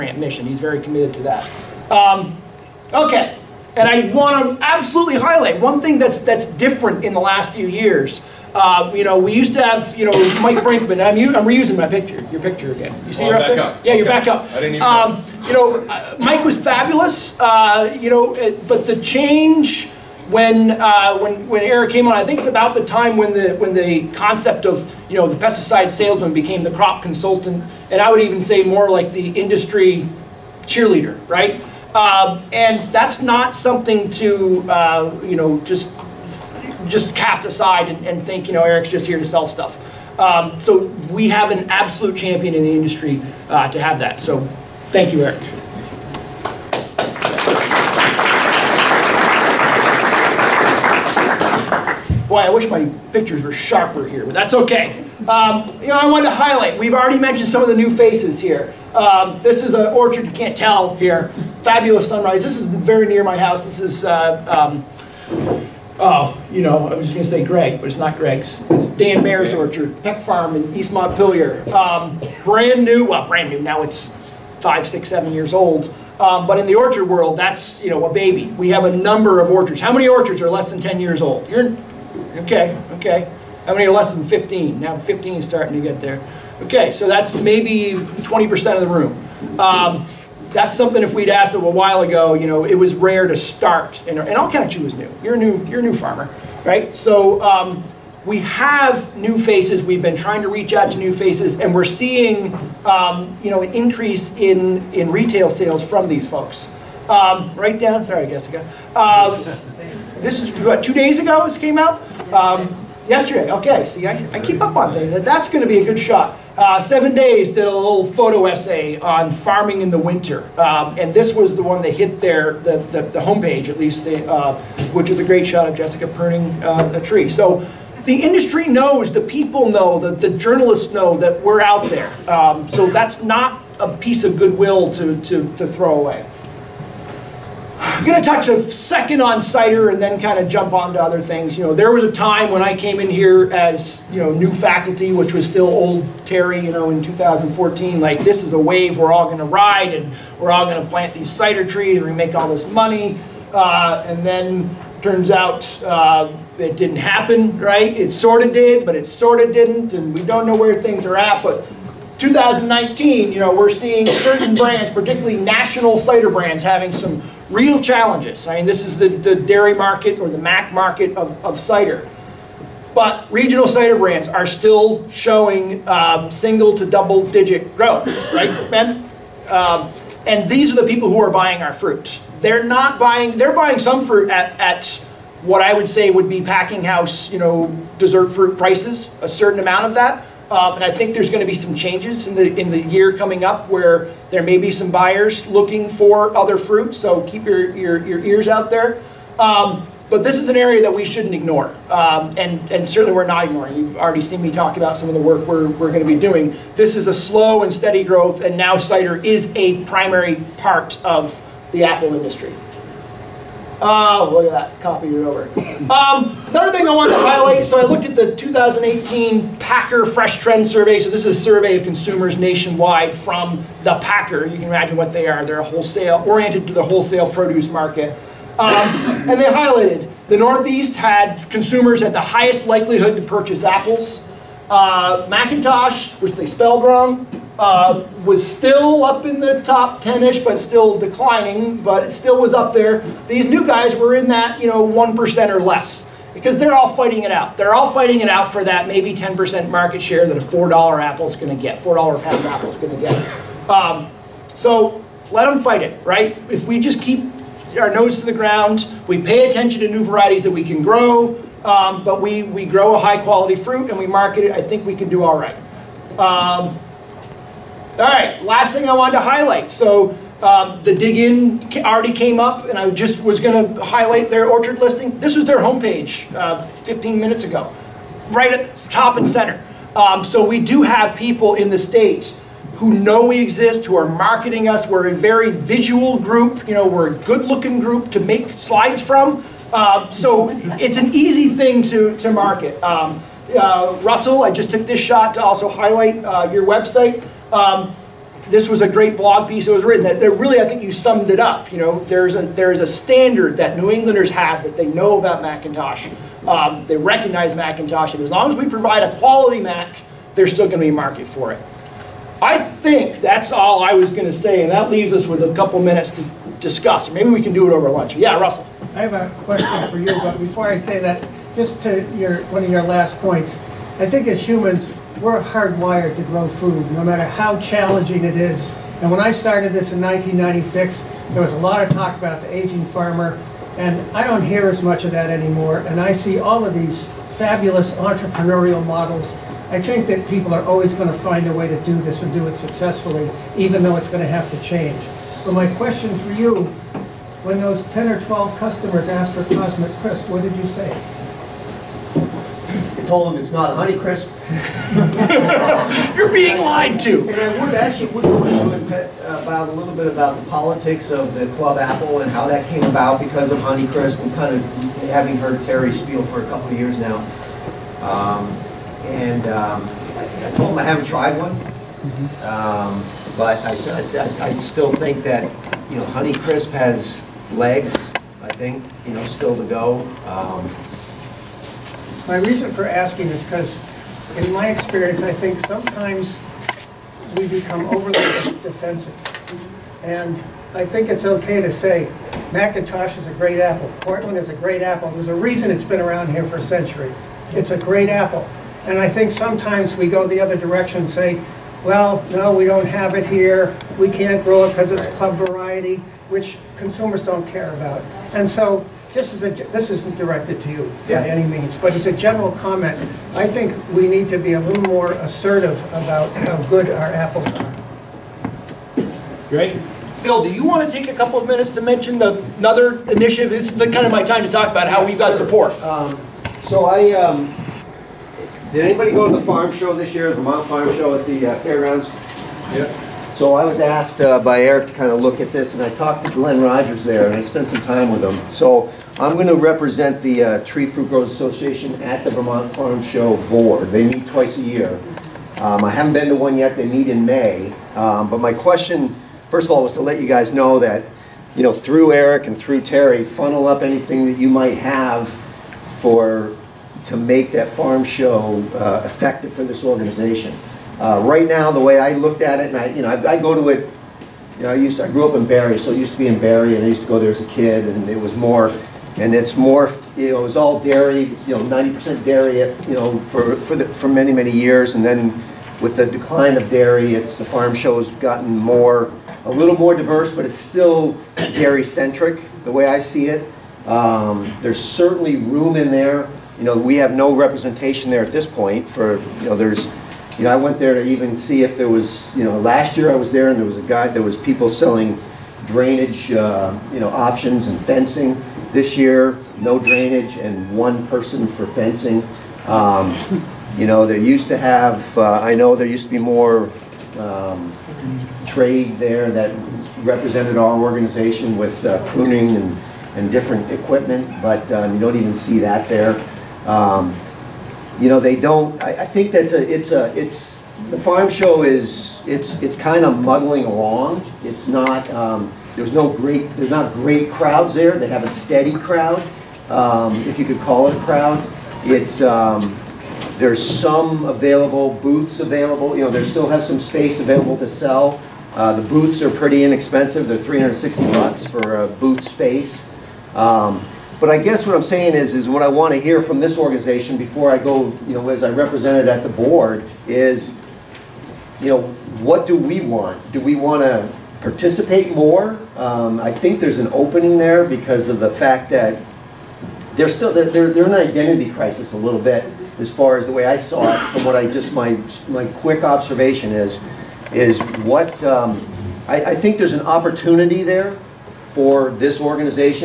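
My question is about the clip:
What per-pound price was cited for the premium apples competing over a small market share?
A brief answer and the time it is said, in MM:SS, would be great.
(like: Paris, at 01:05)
$4 a pound, at 04:11.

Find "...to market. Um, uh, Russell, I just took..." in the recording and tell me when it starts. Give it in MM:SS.
04:52.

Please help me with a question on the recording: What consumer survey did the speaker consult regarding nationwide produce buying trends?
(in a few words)
2018 Packer Fresh Trend Survey.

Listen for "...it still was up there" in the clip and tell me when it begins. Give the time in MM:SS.
04:02.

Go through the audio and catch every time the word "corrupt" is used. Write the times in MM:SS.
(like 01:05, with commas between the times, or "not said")
not said.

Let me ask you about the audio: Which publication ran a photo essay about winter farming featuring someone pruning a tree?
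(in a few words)
Seven Days.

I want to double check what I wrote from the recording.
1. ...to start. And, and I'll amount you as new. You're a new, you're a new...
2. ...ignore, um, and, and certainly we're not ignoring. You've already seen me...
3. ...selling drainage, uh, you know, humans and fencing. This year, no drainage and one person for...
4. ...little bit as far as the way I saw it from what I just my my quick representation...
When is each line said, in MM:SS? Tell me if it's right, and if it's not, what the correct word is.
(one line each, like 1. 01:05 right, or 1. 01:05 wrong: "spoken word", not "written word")
1. 01:33 wrong: "count", not "amount"
2. 03:21 right
3. 08:14 wrong: "options", not "humans"
4. 09:21 wrong: "observation", not "representation".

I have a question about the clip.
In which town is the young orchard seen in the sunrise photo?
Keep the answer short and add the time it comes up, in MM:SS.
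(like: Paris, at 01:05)
East Montpelier, at 01:10.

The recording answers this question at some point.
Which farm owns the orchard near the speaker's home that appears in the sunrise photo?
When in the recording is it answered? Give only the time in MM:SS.
01:10.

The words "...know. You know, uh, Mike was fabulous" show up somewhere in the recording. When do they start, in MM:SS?
00:15.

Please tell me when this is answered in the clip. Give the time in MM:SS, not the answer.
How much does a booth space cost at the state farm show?
09:00.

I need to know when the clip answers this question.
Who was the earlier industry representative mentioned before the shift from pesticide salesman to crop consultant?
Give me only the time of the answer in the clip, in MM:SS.
00:10.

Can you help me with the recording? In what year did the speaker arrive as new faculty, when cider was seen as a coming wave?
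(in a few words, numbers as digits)
2014.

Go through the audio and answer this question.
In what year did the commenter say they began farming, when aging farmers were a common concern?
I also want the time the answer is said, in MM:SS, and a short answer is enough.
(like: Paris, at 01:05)
1996, at 05:30.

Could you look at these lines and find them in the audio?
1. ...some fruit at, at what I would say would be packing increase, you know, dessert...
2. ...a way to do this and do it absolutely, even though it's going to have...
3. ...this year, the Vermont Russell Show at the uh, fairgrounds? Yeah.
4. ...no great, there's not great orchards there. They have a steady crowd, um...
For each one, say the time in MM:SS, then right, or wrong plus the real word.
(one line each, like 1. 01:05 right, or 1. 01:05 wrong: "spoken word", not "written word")
1. 03:03 wrong: "house", not "increase"
2. 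05:41 wrong: "successfully", not "absolutely"
3. 07:09 wrong: "Farm", not "Russell"
4. 08:45 wrong: "crowds", not "orchards".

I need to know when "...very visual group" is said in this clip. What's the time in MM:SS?
04:45.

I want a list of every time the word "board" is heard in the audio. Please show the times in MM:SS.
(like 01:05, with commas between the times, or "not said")
07:23, 09:09.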